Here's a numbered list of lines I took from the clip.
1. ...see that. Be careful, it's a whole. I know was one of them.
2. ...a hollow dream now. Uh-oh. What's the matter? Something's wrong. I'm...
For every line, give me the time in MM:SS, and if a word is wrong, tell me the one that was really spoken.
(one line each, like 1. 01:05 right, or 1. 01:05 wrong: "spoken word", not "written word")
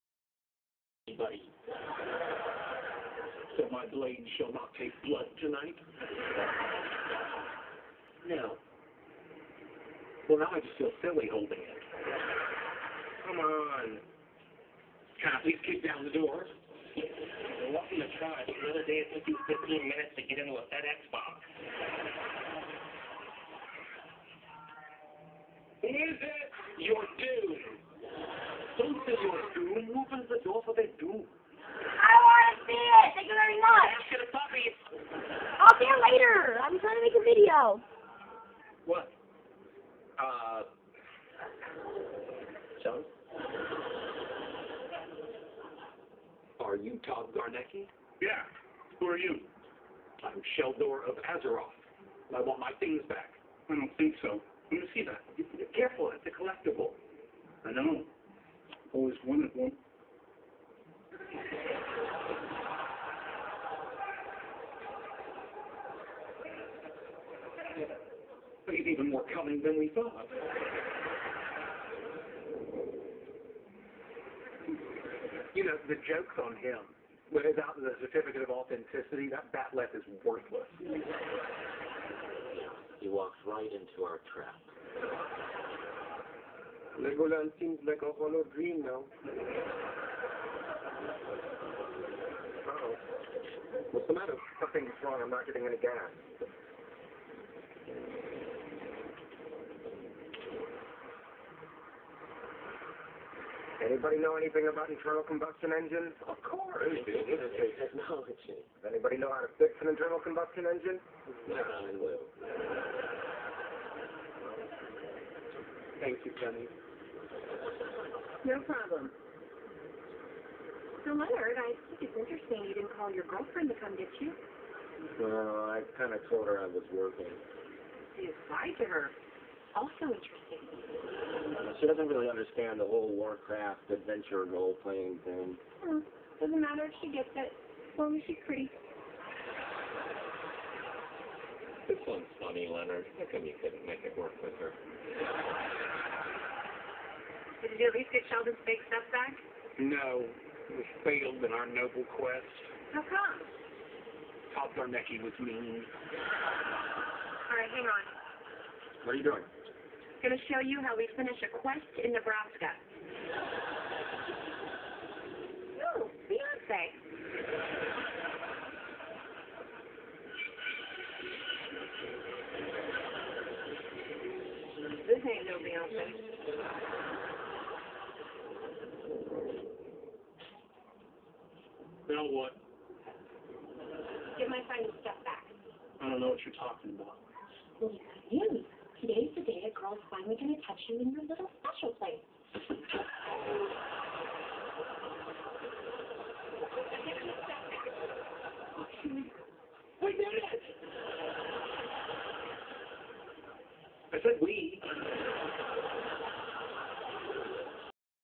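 1. 00:54 wrong: "collectible", not "whole"
2. 01:28 right.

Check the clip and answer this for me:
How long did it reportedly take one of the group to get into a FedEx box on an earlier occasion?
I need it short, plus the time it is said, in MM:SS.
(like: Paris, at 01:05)
15 minutes, at 00:19.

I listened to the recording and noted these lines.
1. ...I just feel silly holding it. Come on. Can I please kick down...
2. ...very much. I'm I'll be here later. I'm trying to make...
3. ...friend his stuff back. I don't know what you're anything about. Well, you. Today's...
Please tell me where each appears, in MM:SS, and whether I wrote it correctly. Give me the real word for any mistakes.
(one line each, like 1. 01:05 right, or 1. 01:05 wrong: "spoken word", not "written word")
1. 00:10 right
2. 00:33 right
3. 03:04 wrong: "talking", not "anything".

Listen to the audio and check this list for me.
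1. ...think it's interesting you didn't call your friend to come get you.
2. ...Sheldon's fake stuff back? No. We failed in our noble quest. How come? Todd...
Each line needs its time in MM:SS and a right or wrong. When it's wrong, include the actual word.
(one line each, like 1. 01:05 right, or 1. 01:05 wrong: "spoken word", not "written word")
1. 02:01 wrong: "girlfriend", not "friend"
2. 02:28 right.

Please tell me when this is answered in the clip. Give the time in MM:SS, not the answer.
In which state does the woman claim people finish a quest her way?
02:42.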